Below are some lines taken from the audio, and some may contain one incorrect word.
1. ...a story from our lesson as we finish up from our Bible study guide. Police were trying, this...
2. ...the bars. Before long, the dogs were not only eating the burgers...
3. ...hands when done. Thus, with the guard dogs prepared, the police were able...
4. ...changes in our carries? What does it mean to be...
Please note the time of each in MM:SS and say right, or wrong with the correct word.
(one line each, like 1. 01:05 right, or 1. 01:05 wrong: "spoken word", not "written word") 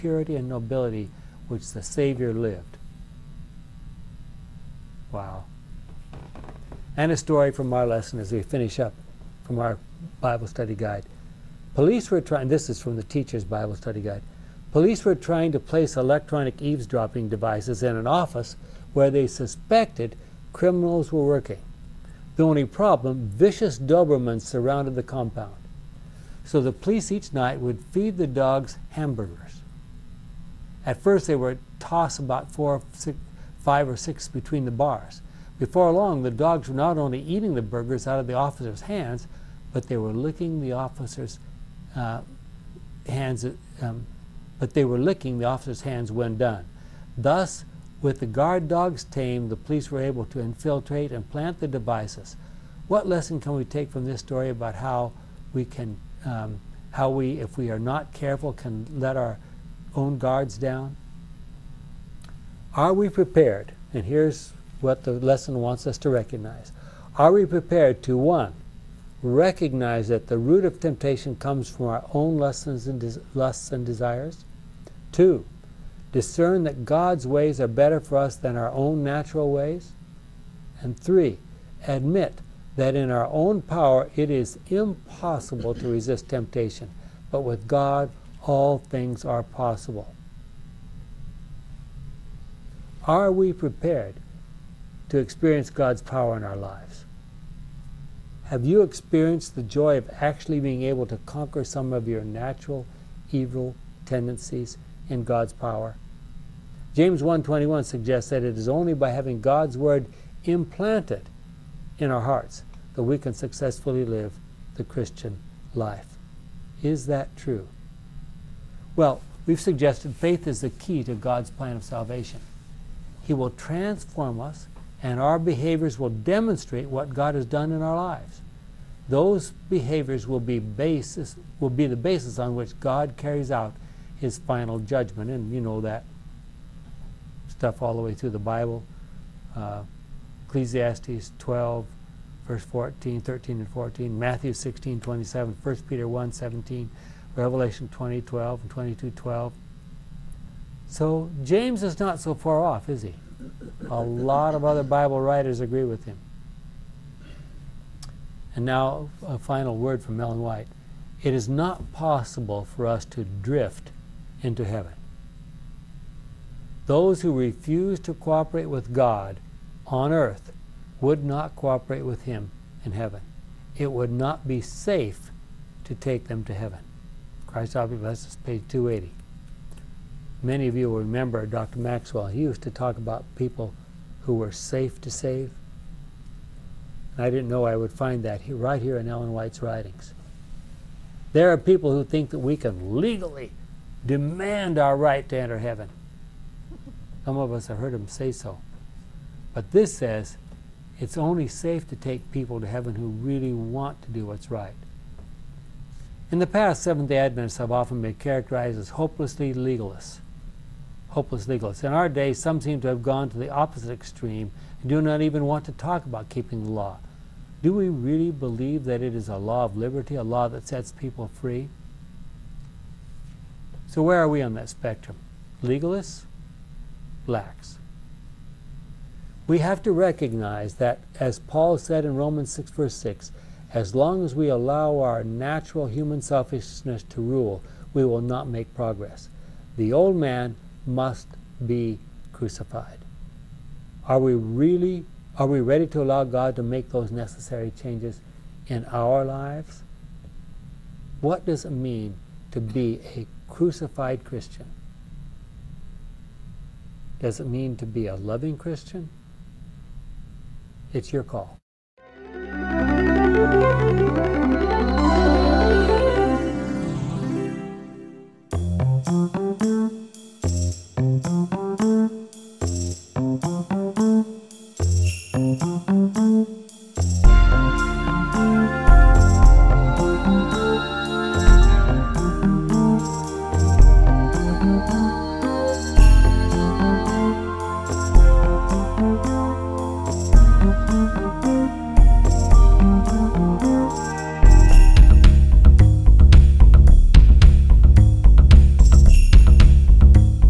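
1. 00:07 right
2. 00:34 right
3. 00:45 wrong: "tamed", not "prepared"
4. 04:07 wrong: "lives", not "carries".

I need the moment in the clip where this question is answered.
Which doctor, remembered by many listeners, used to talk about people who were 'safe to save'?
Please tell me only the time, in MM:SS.
03:01.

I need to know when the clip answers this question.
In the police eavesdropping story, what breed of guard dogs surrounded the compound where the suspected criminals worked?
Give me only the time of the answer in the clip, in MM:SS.
00:23.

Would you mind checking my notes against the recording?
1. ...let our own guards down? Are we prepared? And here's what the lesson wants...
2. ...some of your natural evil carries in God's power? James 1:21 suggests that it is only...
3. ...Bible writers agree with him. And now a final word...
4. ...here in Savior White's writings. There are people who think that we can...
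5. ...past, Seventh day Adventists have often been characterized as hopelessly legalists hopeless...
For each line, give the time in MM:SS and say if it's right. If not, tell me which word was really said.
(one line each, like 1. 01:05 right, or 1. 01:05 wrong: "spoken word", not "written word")
1. 00:58 right
2. 01:41 wrong: "tendencies", not "carries"
3. 02:34 right
4. 03:08 wrong: "Ellen", not "Savior"
5. 03:26 right.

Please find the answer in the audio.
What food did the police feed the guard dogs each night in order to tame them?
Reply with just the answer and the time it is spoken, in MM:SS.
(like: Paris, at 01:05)
Hamburgers, at 00:28.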